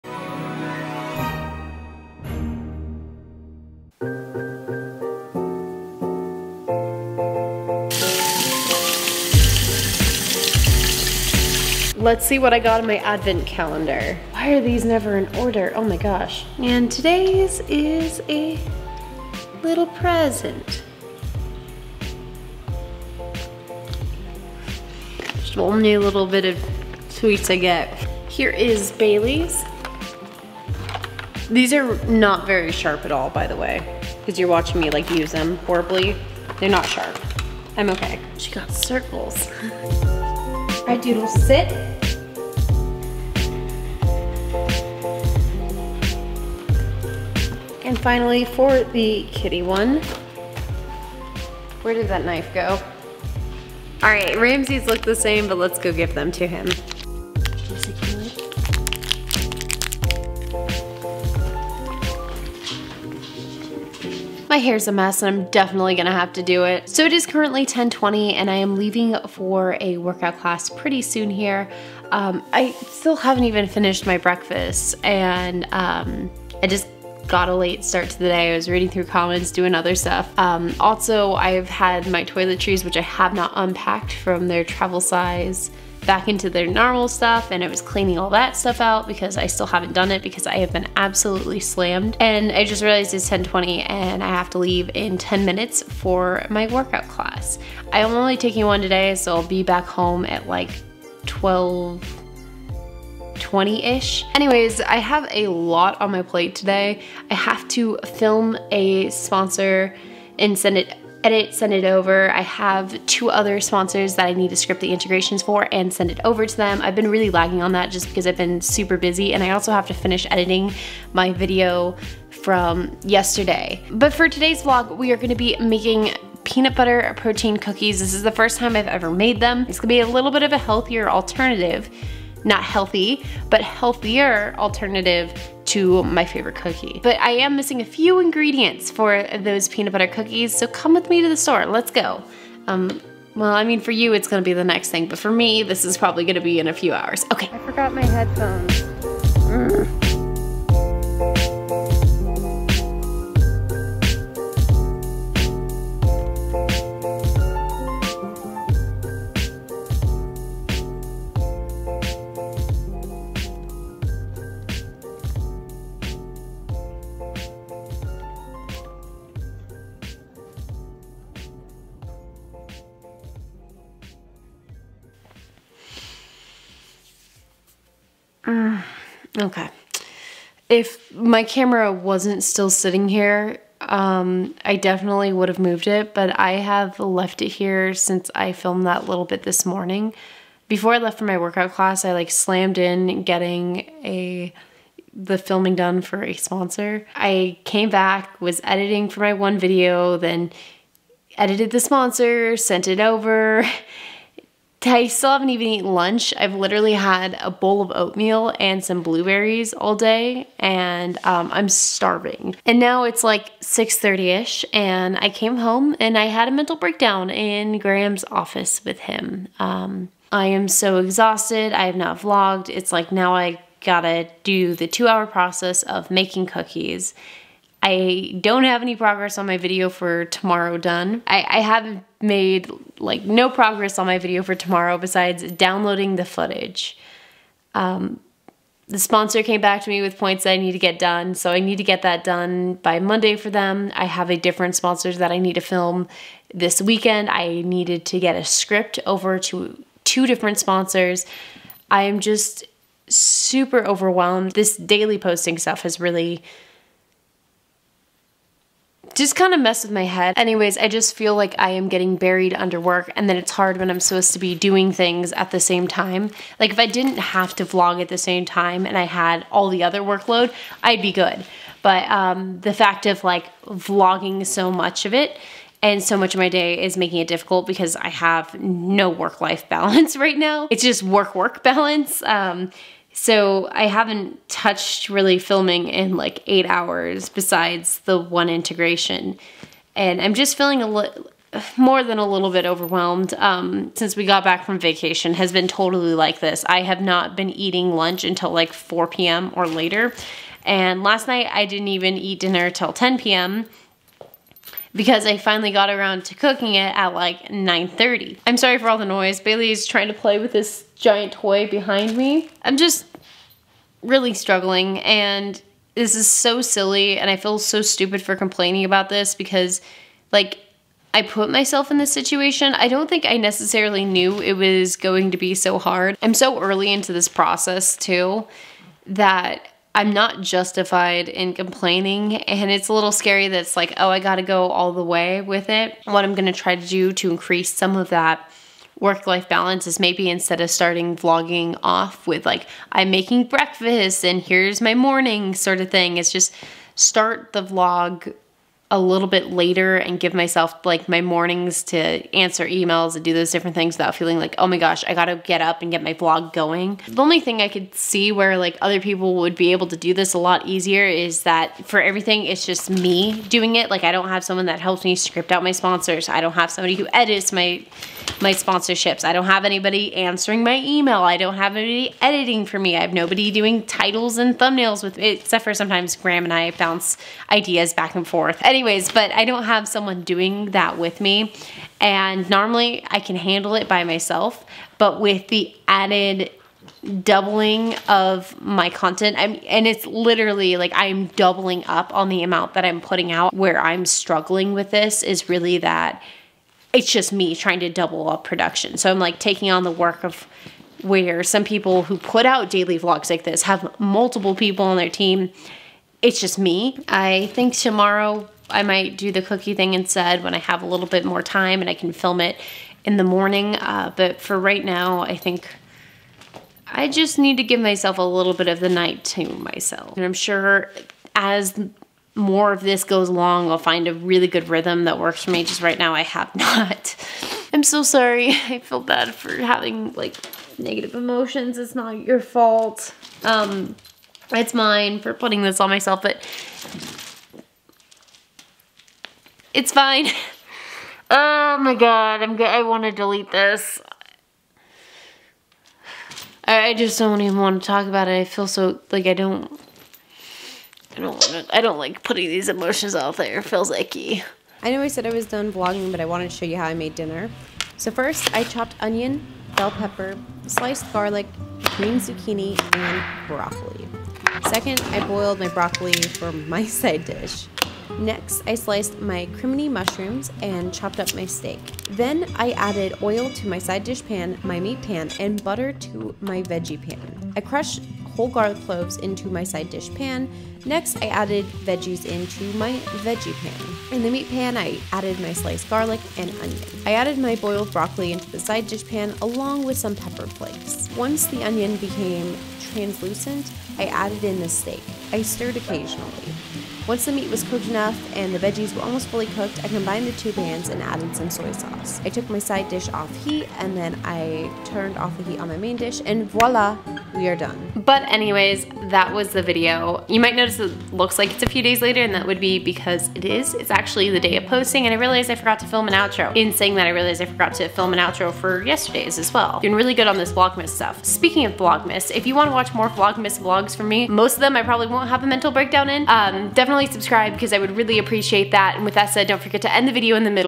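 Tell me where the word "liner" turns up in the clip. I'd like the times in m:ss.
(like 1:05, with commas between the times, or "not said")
not said.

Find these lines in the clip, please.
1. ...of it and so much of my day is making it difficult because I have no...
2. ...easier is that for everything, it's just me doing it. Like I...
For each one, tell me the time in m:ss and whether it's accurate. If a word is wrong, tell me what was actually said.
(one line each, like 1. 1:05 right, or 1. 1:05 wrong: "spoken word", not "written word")
1. 4:35 right
2. 6:00 right.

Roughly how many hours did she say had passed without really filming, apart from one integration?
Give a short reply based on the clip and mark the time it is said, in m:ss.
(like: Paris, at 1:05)
8, at 4:46.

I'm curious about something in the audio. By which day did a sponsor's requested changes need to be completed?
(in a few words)
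Monday.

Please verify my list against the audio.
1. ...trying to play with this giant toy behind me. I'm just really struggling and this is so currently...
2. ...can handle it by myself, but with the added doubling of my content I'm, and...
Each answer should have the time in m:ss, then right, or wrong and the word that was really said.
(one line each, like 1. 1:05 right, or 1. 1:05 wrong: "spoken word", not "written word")
1. 5:09 wrong: "silly", not "currently"
2. 6:23 right.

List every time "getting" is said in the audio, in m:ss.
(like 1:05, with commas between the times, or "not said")
3:13, 4:21.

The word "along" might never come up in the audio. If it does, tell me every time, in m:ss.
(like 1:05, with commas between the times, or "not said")
7:03, 8:09.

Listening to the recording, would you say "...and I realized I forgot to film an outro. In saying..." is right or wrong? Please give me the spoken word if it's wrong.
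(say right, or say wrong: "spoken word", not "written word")
right.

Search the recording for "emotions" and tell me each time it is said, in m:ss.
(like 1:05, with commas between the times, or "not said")
7:11, 7:32.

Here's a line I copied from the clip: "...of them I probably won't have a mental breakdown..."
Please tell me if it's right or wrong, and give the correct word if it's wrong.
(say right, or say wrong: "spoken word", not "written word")
right.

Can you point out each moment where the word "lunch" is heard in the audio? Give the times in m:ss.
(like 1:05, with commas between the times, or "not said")
3:25, 4:57.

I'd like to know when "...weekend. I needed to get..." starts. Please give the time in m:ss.
4:06.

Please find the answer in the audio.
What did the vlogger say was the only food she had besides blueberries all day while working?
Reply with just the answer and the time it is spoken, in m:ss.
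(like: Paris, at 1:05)
Oatmeal, at 3:27.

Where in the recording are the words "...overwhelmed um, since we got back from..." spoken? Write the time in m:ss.
4:52.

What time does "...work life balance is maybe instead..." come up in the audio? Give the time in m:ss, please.
5:38.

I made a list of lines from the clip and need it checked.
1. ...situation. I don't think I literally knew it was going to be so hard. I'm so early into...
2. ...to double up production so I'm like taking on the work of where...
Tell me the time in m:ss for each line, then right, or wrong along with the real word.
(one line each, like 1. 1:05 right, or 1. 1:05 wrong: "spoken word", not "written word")
1. 5:22 wrong: "necessarily", not "literally"
2. 6:37 right.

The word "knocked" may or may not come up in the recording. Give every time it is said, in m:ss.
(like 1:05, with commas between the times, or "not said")
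not said.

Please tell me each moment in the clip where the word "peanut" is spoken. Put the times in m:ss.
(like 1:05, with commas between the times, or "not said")
2:06, 2:19.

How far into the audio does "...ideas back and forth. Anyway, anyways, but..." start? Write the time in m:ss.
6:17.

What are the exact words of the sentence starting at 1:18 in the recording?
I was reading through comments, doing other stuff.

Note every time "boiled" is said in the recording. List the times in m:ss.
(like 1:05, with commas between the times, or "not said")
7:45, 8:07.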